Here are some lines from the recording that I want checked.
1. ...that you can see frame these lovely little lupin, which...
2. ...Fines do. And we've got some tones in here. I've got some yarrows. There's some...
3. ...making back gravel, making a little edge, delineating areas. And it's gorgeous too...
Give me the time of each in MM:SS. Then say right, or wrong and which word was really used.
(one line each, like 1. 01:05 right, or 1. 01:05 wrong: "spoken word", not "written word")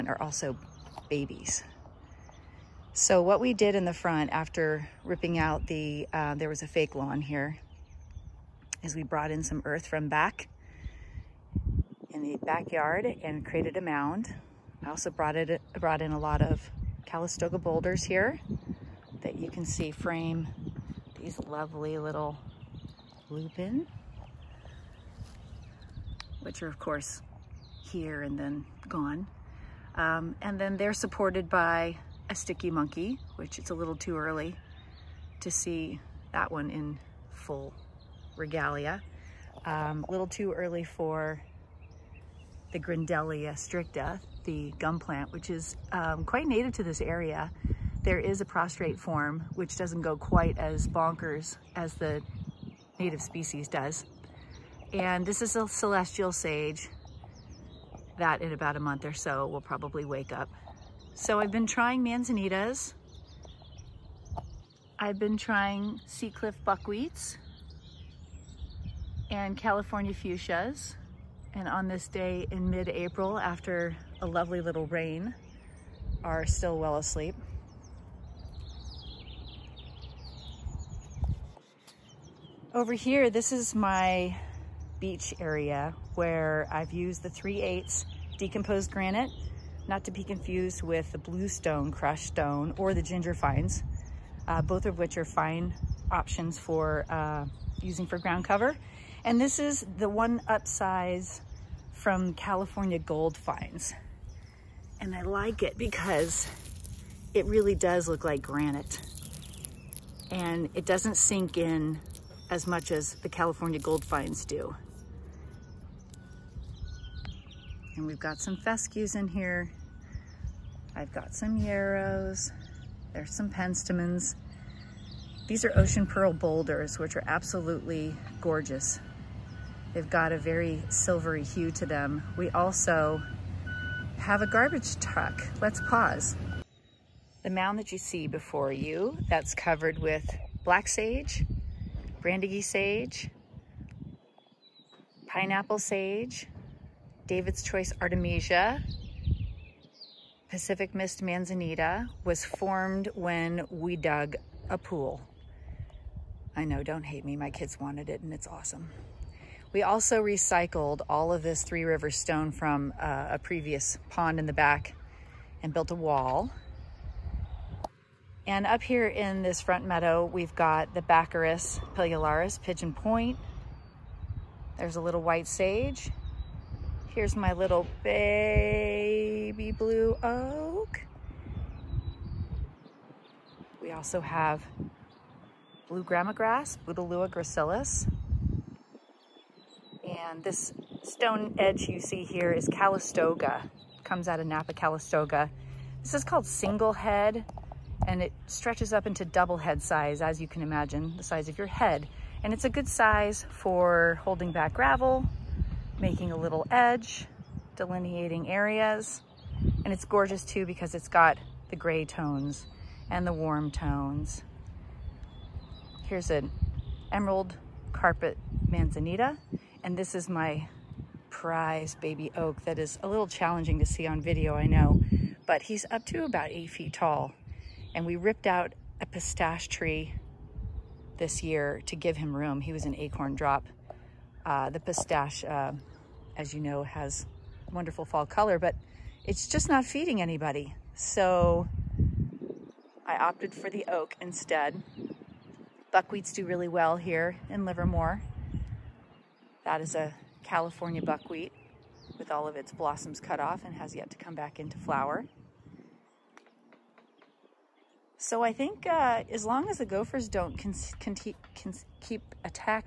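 1. 00:19 right
2. 01:54 wrong: "fescues", not "tones"
3. 03:24 wrong: "holding", not "making".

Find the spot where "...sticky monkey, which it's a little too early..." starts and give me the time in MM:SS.
00:32.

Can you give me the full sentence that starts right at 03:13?
It comes out of Napa, Calistoga.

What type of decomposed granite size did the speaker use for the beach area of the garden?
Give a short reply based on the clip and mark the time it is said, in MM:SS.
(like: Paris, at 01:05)
3/8, at 01:27.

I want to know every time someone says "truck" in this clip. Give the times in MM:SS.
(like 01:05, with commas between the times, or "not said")
02:14.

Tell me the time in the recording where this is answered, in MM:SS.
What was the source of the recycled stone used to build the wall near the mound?
02:43.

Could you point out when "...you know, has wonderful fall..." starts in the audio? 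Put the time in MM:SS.
03:56.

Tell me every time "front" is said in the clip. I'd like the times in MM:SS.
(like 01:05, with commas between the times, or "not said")
00:03, 02:49.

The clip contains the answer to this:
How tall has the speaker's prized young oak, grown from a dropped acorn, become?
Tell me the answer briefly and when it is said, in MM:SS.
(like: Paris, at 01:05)
About 8 feet, at 03:46.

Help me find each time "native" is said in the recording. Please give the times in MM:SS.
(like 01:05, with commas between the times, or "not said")
00:46, 00:52.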